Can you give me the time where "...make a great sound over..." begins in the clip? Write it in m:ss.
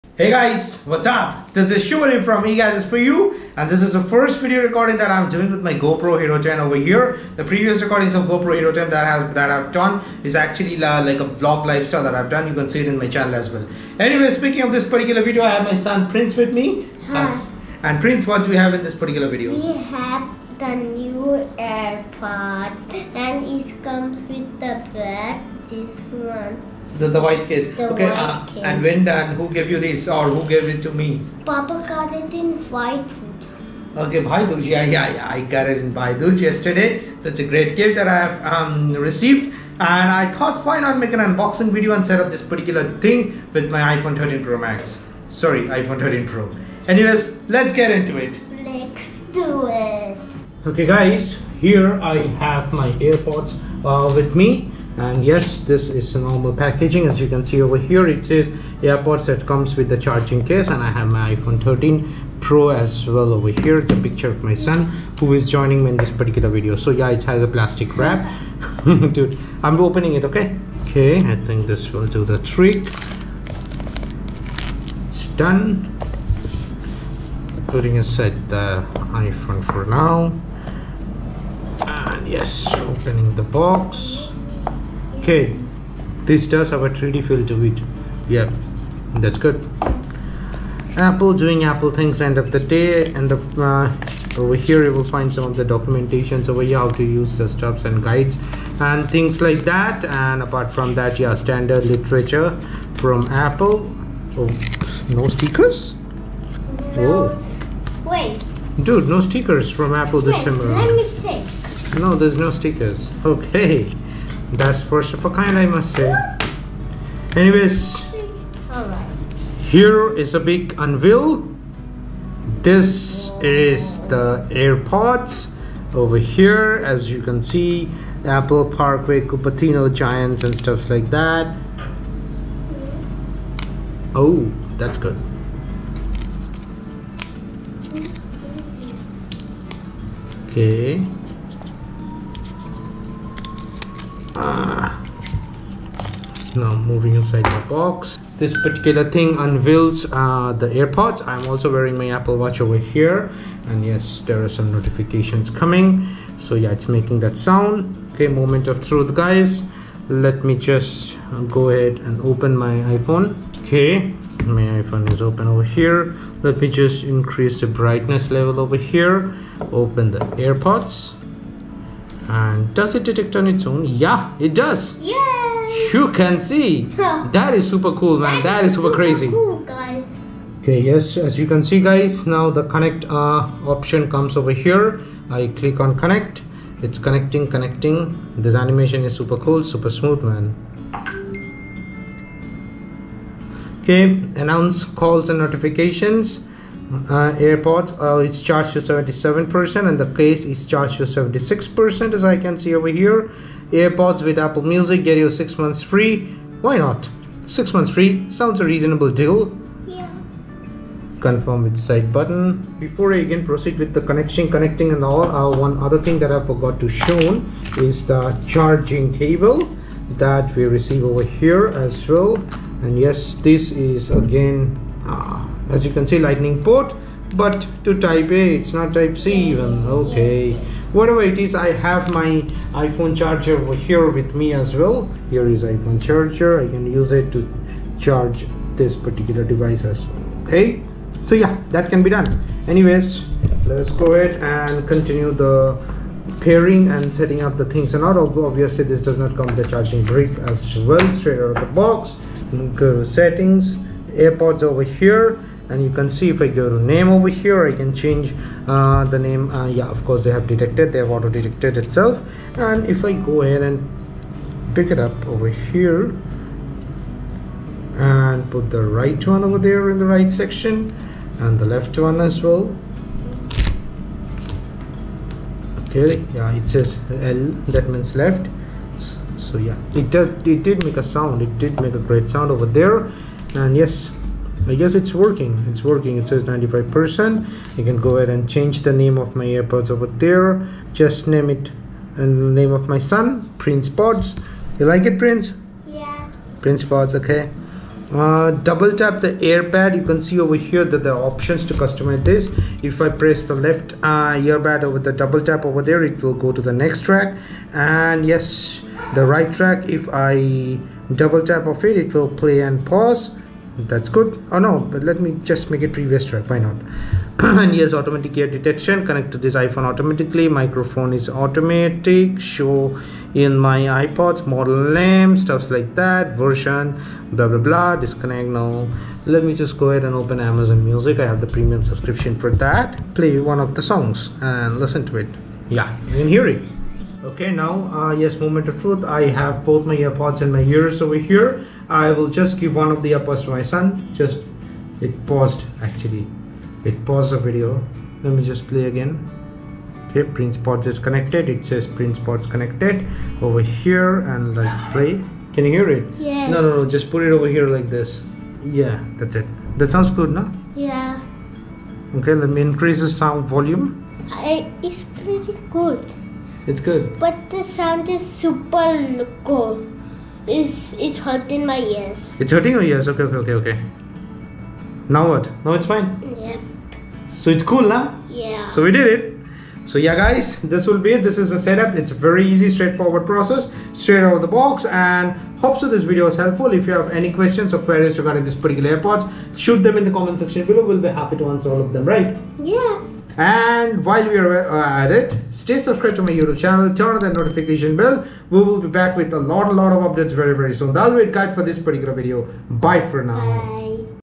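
4:41.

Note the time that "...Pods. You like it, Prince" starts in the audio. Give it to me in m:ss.
4:53.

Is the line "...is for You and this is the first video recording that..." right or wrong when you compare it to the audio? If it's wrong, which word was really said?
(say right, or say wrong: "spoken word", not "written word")
right.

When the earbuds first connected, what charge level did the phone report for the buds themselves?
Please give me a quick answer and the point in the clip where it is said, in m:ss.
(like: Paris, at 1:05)
77%, at 3:18.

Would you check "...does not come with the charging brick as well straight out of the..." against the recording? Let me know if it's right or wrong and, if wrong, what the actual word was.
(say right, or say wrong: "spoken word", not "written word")
right.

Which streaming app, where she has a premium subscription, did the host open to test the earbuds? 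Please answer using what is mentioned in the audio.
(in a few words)
Amazon Music.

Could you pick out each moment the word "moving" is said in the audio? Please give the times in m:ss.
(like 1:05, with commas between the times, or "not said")
2:26.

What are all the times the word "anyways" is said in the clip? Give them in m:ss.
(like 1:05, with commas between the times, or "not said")
0:13, 0:46, 1:57, 4:02.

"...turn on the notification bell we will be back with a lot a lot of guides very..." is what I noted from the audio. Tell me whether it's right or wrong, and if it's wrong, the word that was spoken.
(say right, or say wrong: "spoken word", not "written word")
wrong: "updates", not "guides".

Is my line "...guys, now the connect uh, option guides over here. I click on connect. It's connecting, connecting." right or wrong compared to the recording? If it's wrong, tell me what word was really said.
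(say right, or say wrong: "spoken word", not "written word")
wrong: "comes", not "guides".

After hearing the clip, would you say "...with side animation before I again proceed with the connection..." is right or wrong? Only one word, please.
wrong.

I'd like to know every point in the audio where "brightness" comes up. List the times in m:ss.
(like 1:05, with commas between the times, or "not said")
2:47.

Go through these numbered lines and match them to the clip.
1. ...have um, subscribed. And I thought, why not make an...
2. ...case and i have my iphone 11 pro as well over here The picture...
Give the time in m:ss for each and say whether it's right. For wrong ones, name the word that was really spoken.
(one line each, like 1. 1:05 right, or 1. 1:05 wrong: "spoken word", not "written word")
1. 0:38 wrong: "received", not "subscribed"
2. 1:00 wrong: "13", not "11".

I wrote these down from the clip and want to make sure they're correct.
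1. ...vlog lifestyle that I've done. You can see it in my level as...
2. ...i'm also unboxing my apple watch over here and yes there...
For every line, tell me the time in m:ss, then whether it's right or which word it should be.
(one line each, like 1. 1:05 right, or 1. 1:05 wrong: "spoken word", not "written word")
1. 0:11 wrong: "channel", not "level"
2. 2:31 wrong: "wearing", not "unboxing".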